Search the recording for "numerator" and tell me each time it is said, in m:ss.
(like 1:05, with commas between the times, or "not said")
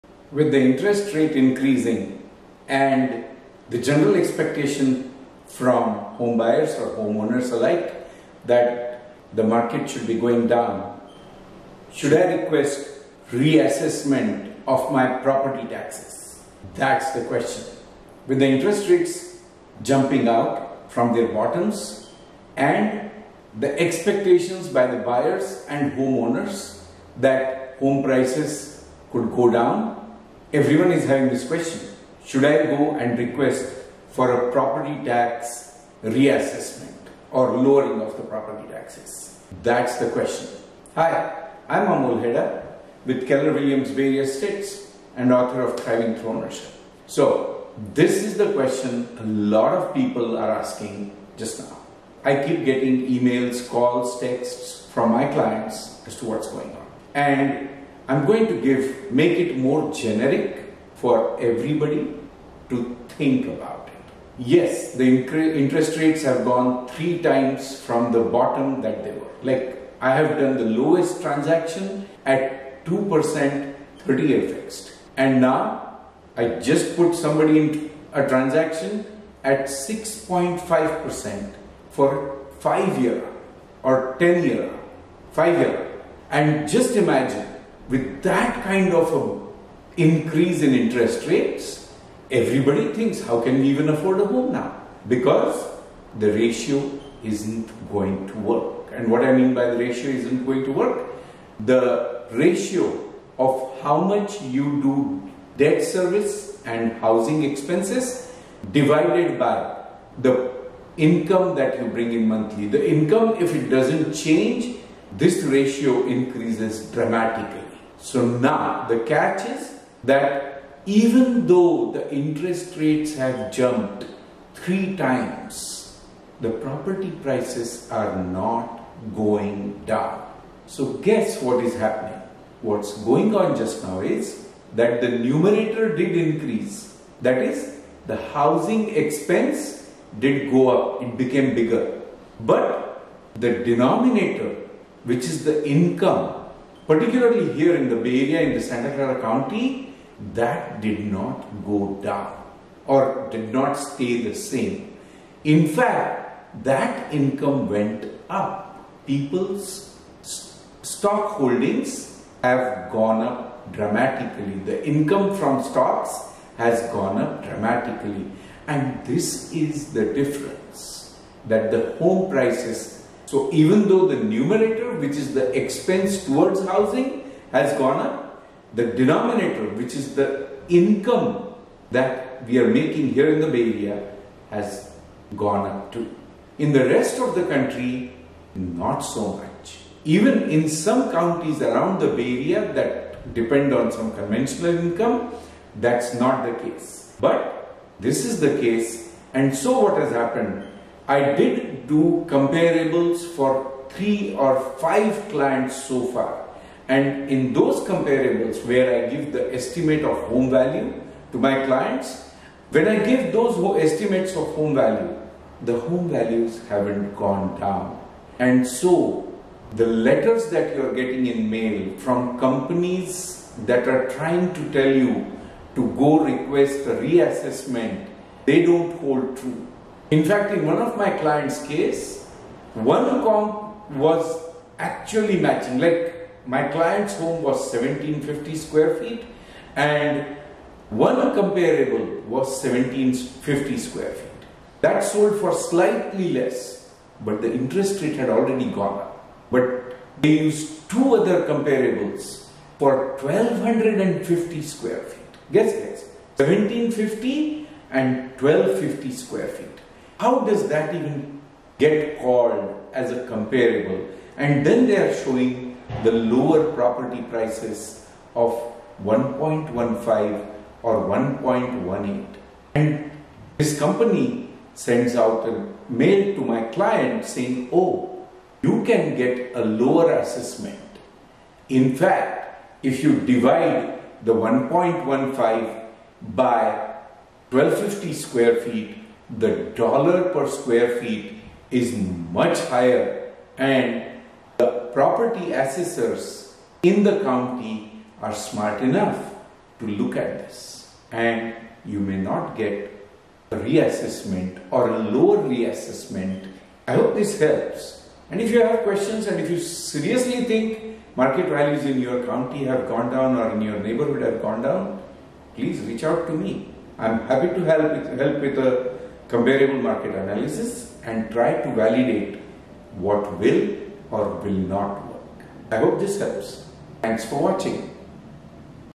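2:15, 2:54.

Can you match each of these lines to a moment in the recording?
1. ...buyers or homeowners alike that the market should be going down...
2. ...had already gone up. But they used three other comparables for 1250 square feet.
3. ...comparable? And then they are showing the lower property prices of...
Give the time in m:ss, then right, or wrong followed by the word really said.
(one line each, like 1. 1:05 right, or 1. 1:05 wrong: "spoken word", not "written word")
1. 0:06 right
2. 4:08 wrong: "two", not "three"
3. 4:23 right.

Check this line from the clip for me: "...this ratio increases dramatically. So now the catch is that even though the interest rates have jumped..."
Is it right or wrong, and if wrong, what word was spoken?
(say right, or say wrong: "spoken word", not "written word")
right.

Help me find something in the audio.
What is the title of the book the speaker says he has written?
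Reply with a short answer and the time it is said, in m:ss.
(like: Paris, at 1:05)
Thriving Through Ownership, at 0:45.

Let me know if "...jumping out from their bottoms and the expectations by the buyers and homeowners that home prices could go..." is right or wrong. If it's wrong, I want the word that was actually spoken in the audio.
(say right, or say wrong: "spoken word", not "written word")
right.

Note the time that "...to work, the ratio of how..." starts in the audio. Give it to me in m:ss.
1:40.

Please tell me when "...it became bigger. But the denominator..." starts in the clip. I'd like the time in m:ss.
2:21.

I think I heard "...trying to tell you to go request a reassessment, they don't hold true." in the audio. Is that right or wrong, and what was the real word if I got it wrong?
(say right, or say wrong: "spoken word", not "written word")
right.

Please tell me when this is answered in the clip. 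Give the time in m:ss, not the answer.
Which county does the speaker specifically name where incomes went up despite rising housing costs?
2:28.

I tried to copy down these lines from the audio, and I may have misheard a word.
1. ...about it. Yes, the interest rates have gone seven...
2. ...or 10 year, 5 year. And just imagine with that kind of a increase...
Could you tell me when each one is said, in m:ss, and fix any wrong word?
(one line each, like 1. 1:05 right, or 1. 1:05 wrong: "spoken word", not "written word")
1. 1:03 wrong: "three", not "seven"
2. 1:23 right.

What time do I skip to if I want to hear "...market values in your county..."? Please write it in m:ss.
5:11.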